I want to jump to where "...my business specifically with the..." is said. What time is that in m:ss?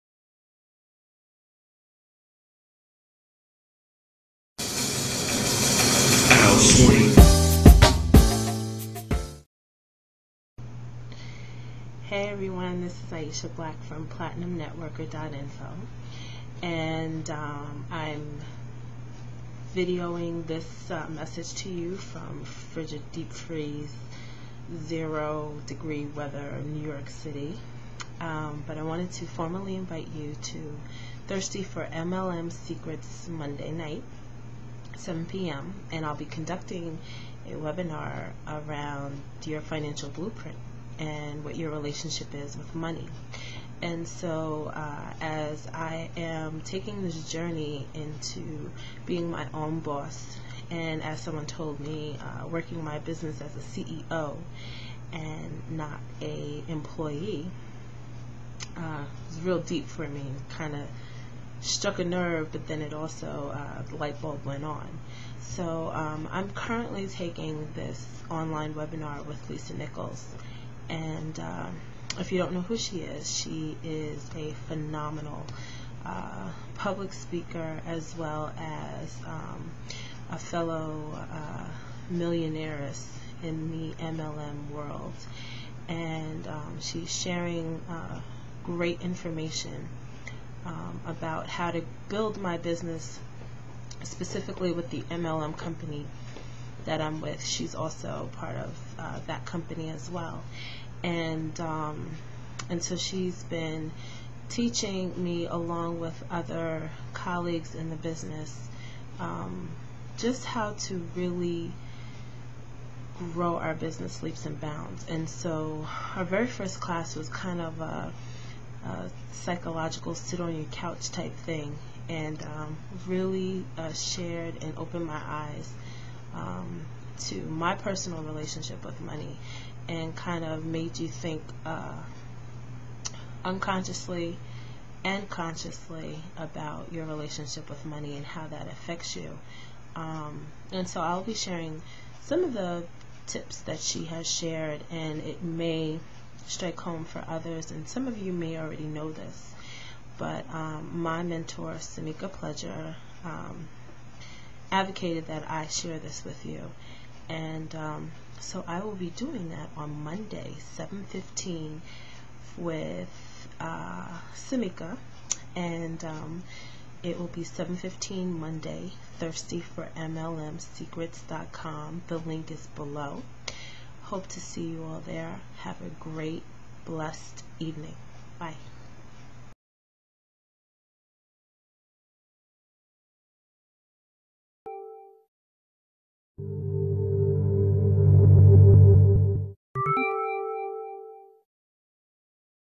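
1:32.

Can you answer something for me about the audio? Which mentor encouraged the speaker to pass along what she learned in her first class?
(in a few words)
Samika Pledger.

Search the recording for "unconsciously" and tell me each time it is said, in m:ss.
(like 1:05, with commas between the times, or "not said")
2:13.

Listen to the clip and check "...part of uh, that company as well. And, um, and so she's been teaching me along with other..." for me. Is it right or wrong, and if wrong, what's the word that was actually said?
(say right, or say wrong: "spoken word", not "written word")
right.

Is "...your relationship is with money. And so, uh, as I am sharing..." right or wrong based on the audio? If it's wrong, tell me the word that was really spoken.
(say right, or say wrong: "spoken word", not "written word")
wrong: "taking", not "sharing".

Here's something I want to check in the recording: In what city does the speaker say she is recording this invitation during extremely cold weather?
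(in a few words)
New York City.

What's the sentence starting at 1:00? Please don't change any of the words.
Kind of struck a nerve, but then it also, uh, the light bulb went on.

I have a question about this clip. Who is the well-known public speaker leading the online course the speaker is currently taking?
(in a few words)
Lisa Nichols.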